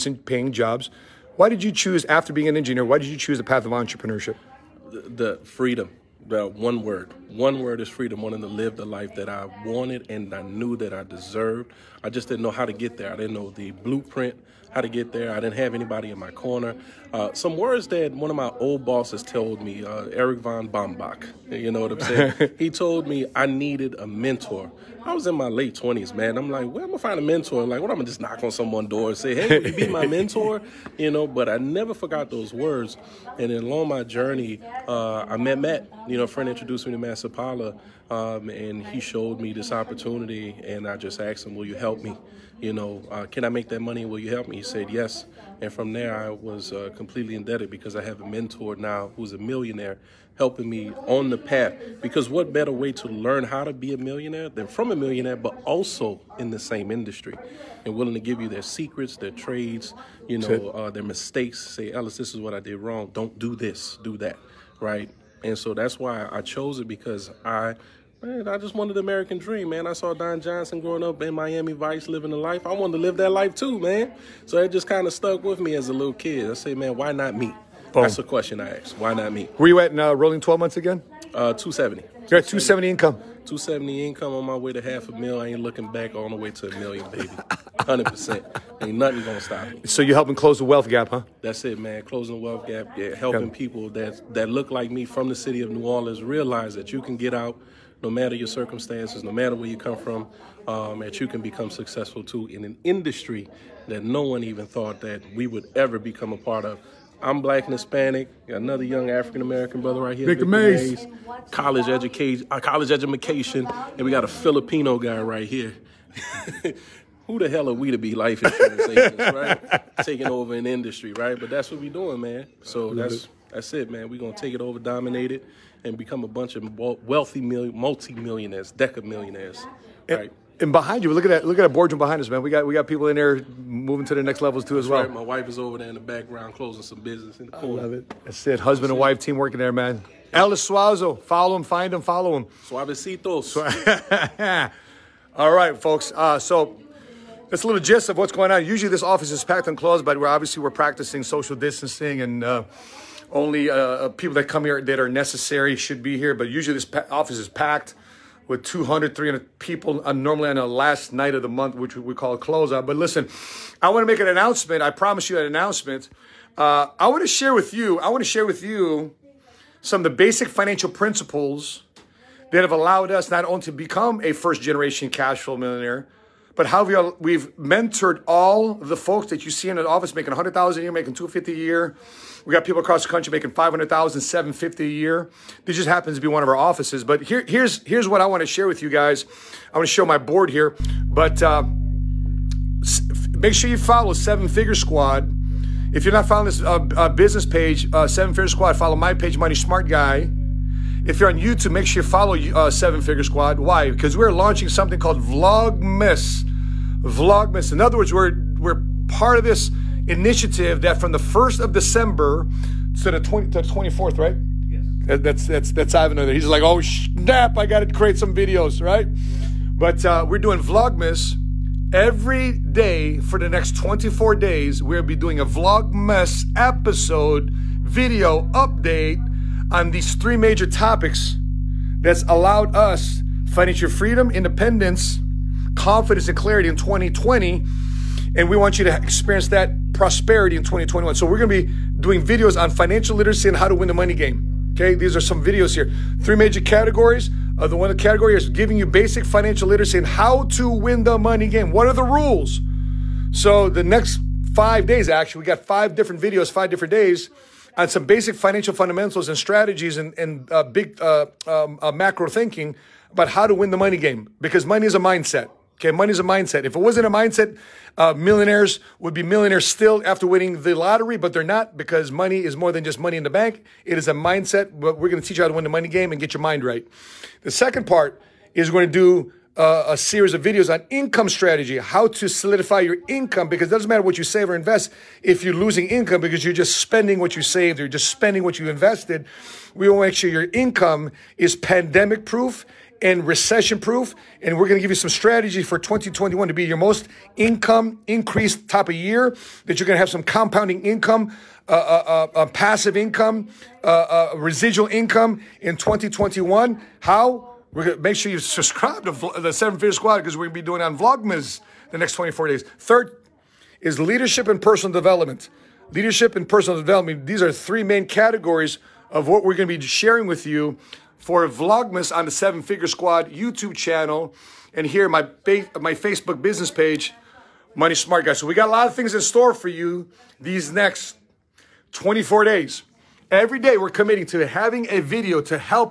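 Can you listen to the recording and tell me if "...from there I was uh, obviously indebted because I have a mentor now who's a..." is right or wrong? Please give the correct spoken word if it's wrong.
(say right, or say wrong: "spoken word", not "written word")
wrong: "completely", not "obviously".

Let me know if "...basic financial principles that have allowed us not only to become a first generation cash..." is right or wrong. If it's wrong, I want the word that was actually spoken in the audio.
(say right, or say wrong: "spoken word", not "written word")
right.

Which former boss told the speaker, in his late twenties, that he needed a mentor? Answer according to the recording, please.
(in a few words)
Eric von Bombach.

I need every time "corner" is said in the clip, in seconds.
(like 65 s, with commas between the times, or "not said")
16 s, 137 s.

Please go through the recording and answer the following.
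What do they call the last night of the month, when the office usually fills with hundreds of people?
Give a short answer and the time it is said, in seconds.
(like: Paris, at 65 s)
closeout, at 162 s.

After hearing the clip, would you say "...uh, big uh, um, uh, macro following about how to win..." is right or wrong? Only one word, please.
wrong.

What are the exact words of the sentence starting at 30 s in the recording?
You know, but I never forgot those words.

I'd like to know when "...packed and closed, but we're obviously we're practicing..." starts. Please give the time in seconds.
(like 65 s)
149 s.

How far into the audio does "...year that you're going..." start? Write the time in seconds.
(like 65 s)
298 s.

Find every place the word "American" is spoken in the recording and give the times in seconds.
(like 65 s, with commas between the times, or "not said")
69 s, 109 s.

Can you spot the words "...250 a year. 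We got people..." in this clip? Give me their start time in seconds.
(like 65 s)
181 s.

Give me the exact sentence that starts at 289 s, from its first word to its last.
We want to make sure your income is pandemic proof and recession proof.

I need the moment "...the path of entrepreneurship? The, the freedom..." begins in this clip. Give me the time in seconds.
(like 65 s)
3 s.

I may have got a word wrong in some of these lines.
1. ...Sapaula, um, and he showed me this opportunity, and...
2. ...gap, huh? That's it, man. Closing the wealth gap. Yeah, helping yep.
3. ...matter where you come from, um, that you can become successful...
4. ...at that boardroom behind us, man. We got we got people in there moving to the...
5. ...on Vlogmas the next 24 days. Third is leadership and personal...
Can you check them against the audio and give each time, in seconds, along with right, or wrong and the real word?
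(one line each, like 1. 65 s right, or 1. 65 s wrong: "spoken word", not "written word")
1. 37 s right
2. 90 s right
3. 99 s right
4. 131 s right
5. 310 s right.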